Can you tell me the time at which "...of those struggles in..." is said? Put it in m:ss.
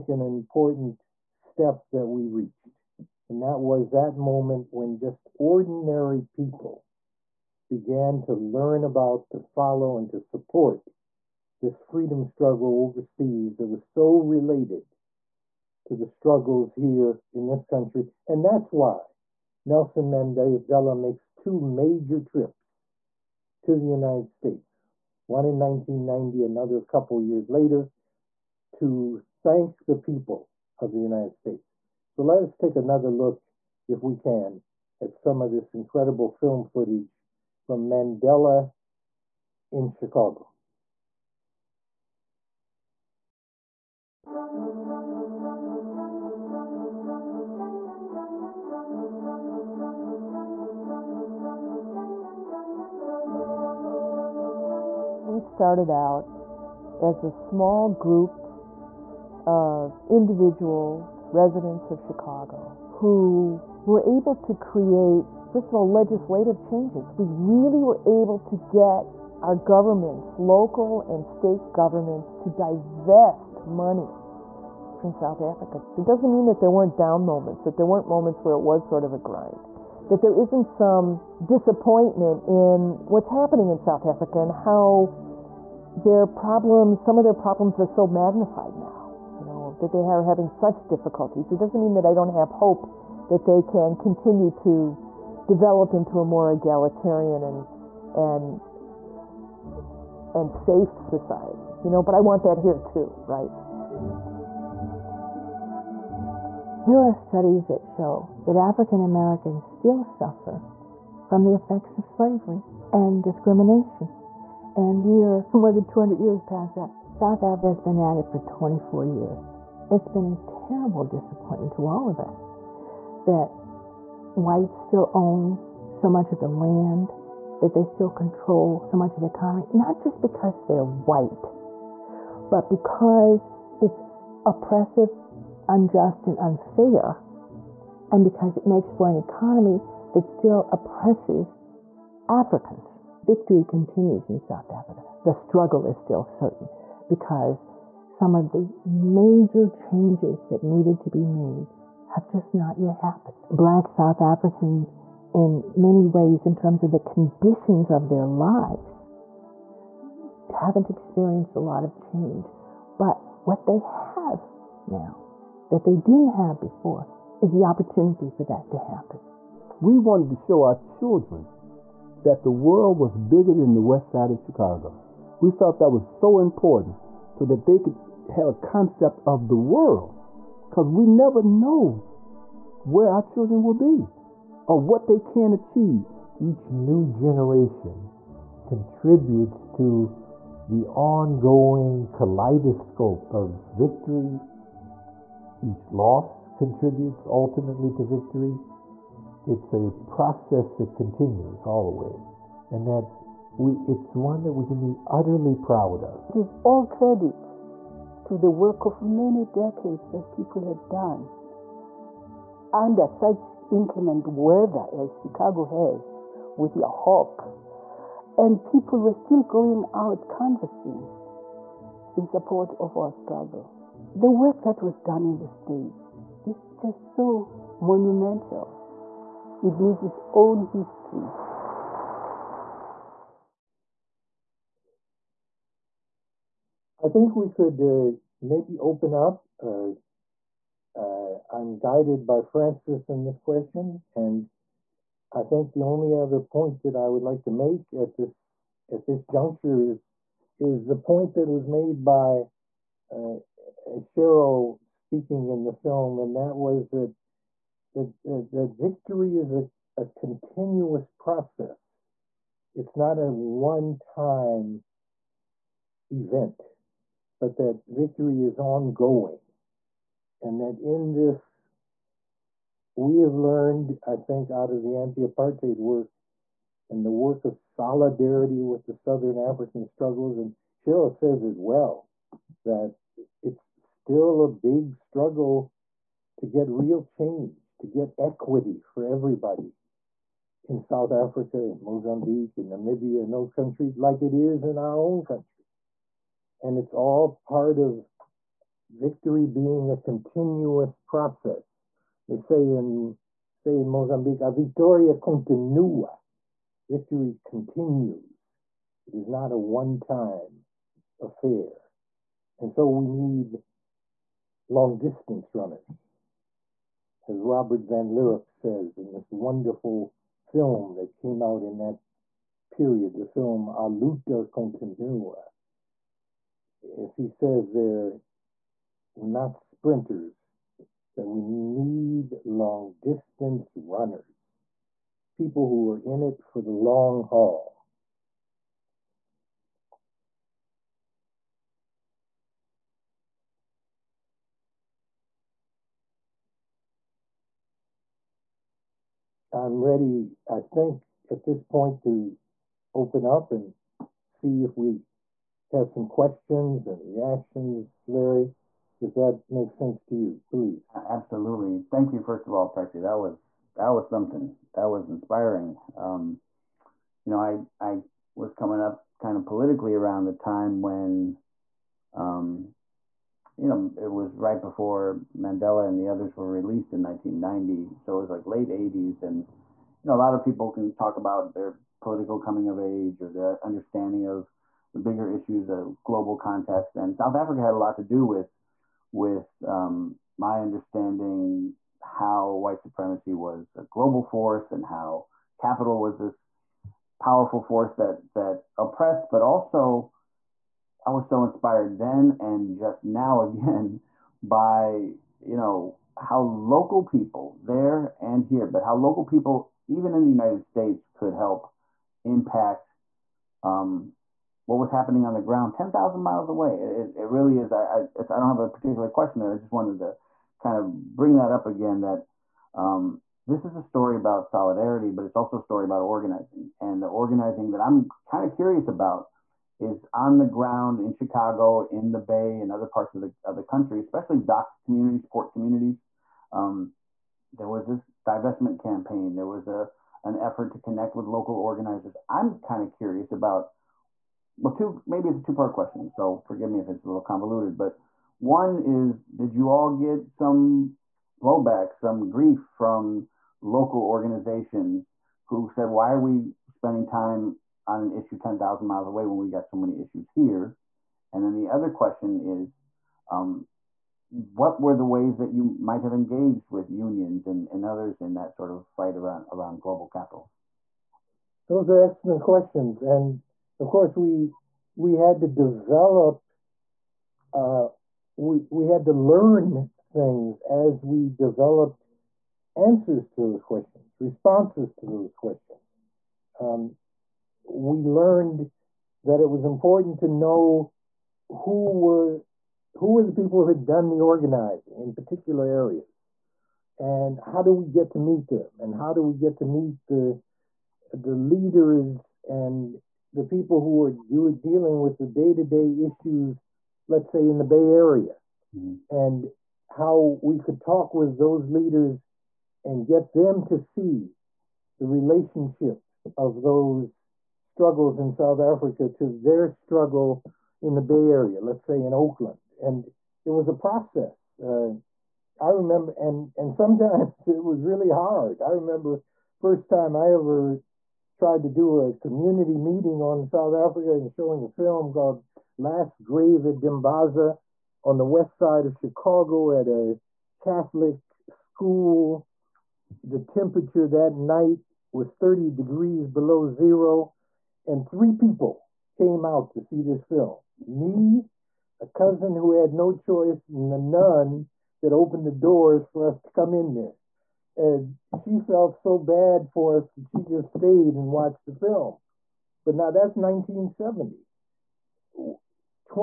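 8:36.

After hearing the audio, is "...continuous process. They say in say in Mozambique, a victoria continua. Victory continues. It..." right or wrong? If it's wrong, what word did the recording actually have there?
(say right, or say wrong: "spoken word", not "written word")
right.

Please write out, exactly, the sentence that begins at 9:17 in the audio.
And she felt so bad for us that she just stayed and watched the film.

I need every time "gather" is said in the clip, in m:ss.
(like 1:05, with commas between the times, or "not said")
not said.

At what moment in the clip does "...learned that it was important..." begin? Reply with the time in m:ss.
8:08.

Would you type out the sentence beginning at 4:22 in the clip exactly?
It's not a one-time event but that victory is ongoing.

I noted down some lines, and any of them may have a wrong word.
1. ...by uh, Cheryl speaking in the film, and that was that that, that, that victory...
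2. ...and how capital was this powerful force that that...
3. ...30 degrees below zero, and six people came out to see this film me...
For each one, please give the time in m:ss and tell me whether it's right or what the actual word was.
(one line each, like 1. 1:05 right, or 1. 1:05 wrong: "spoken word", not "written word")
1. 4:12 right
2. 6:34 right
3. 9:05 wrong: "three", not "six".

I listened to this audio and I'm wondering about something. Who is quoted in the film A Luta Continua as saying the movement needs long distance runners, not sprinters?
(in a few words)
Robert Van Lierop.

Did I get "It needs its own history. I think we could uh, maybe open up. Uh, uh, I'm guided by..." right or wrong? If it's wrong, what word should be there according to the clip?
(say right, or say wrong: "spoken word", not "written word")
right.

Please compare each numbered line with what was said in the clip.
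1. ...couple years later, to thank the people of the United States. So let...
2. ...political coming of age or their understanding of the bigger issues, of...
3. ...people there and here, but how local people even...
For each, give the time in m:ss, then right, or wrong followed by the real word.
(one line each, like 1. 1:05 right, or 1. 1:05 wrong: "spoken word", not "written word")
1. 0:26 right
2. 6:21 right
3. 6:47 right.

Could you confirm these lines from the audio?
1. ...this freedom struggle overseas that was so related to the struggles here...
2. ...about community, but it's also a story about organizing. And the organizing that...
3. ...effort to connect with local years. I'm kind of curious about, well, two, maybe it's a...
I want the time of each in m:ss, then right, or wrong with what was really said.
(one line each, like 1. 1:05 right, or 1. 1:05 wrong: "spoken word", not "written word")
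1. 0:11 right
2. 7:04 wrong: "solidarity", not "community"
3. 7:20 wrong: "organizers", not "years".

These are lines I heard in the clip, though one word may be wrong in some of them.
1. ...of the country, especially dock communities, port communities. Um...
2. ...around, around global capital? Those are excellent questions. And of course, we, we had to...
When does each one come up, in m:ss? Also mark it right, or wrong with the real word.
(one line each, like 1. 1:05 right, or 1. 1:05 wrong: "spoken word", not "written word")
1. 7:13 right
2. 7:49 right.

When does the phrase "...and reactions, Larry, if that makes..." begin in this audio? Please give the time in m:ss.
5:56.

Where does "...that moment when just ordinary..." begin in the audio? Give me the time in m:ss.
0:03.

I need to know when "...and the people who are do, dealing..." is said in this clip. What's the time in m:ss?
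8:22.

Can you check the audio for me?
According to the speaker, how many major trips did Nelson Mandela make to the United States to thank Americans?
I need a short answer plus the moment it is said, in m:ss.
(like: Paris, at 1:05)
2, at 0:21.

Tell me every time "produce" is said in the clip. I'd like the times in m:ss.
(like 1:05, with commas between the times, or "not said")
not said.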